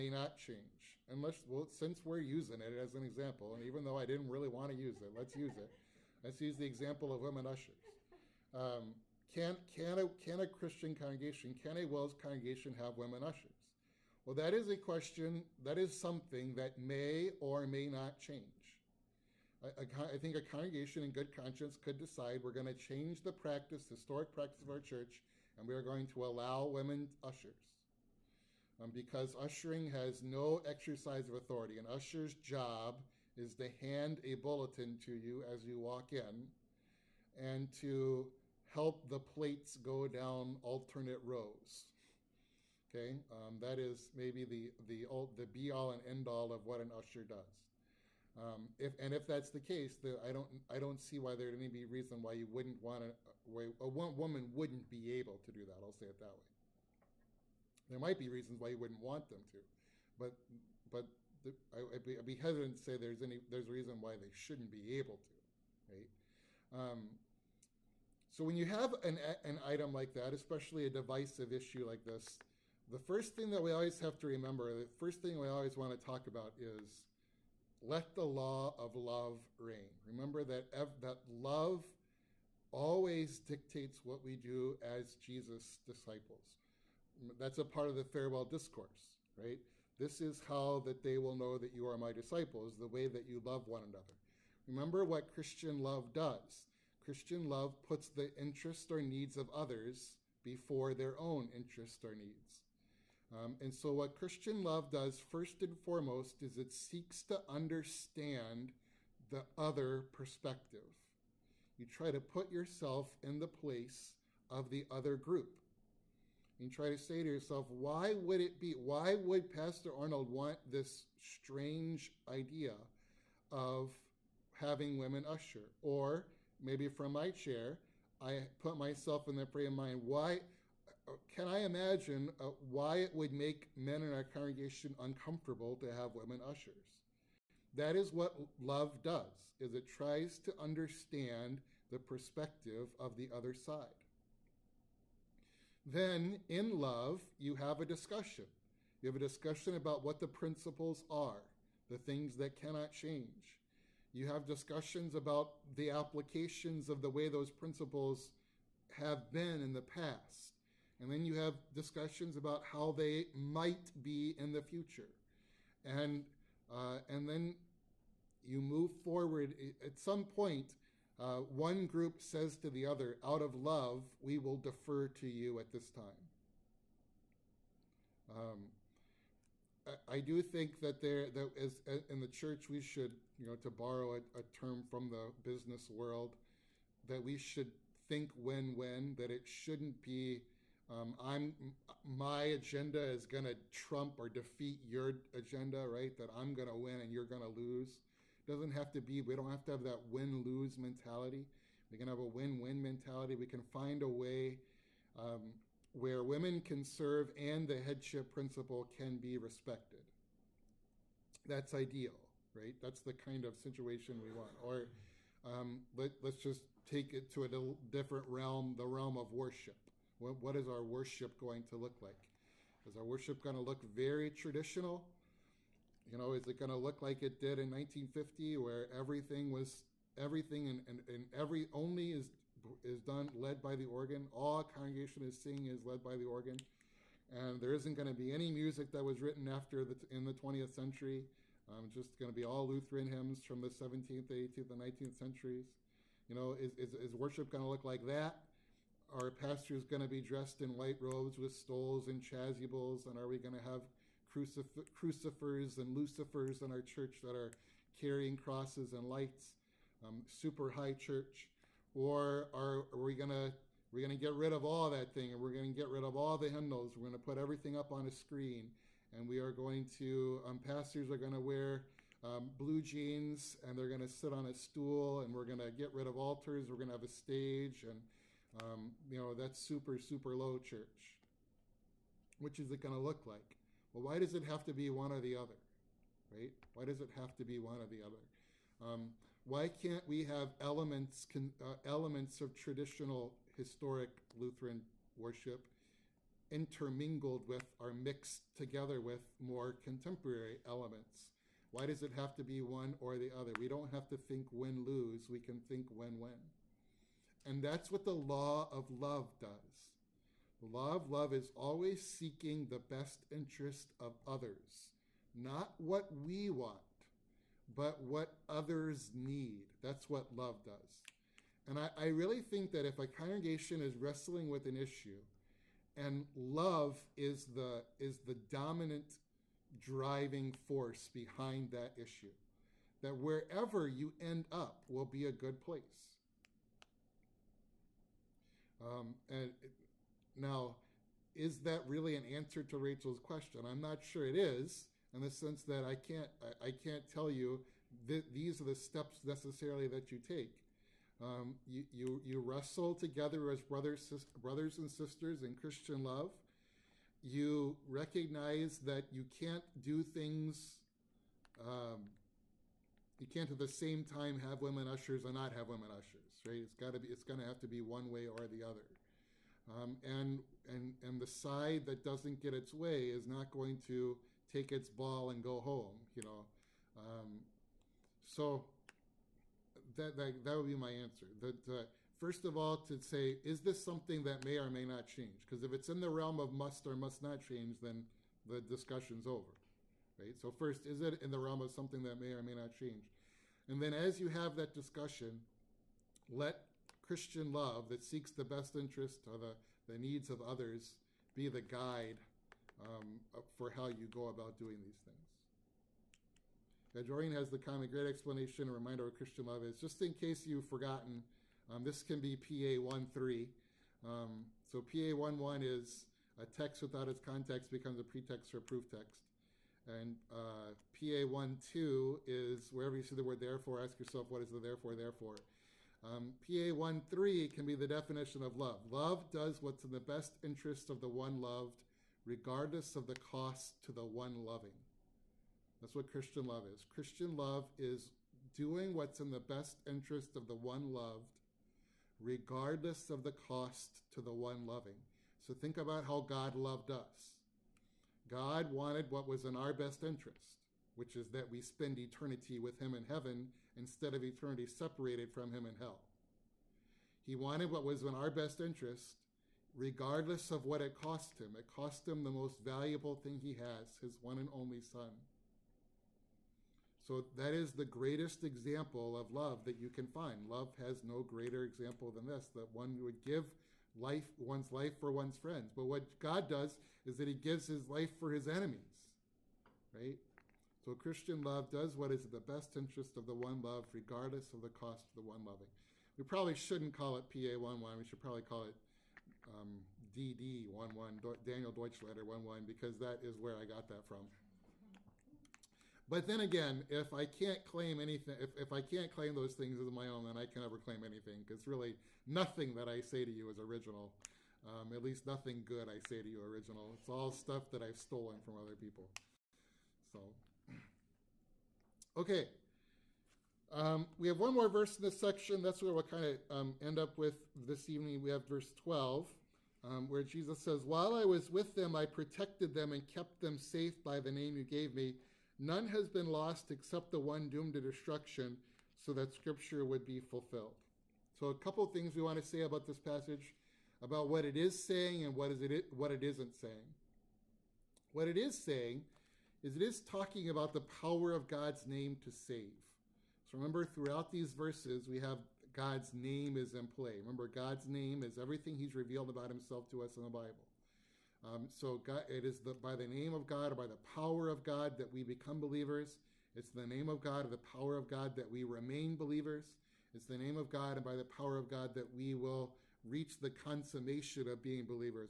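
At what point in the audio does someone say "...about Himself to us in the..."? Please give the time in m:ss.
9:09.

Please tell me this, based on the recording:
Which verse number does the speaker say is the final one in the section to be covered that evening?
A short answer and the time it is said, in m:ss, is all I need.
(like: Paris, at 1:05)
12, at 8:38.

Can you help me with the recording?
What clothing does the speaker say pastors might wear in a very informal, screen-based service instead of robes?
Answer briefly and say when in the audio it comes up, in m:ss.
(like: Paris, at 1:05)
blue jeans, at 4:32.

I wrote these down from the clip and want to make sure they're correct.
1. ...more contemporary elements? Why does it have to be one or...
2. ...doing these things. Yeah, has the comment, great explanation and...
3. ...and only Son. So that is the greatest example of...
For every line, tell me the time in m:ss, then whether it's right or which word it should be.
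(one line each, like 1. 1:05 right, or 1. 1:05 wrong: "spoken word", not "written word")
1. 4:59 right
2. 6:44 right
3. 7:44 right.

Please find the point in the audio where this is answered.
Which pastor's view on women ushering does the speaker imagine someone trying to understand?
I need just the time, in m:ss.
1:59.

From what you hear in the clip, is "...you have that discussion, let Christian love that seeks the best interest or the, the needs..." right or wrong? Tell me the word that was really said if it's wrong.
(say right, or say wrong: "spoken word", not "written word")
right.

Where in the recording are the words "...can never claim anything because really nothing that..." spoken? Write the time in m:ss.
8:20.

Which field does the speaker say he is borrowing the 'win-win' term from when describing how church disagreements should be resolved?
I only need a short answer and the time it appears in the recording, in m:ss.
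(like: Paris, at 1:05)
the business world, at 3:05.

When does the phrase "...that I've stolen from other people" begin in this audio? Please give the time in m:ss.
8:27.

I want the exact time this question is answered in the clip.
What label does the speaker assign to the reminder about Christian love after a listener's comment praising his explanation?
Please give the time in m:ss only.
6:52.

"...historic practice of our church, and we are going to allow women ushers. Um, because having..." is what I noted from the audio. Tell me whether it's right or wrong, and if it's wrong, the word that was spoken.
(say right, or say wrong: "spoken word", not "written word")
wrong: "ushering", not "having".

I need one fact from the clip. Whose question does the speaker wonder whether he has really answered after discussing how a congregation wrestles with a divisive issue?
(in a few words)
Rachel's.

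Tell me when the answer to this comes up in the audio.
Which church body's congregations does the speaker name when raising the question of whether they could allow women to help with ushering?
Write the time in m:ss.
0:11.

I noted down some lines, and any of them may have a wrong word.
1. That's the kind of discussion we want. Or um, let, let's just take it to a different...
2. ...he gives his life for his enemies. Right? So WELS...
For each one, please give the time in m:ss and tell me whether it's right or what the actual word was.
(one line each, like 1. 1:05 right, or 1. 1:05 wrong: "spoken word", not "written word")
1. 3:32 wrong: "situation", not "discussion"
2. 7:57 wrong: "Christian", not "WELS".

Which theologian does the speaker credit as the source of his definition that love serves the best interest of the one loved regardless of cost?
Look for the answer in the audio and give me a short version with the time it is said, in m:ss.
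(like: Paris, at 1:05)
Daniel Deutschlander, at 8:11.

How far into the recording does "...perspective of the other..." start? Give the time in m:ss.
2:21.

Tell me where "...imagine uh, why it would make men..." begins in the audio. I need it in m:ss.
2:11.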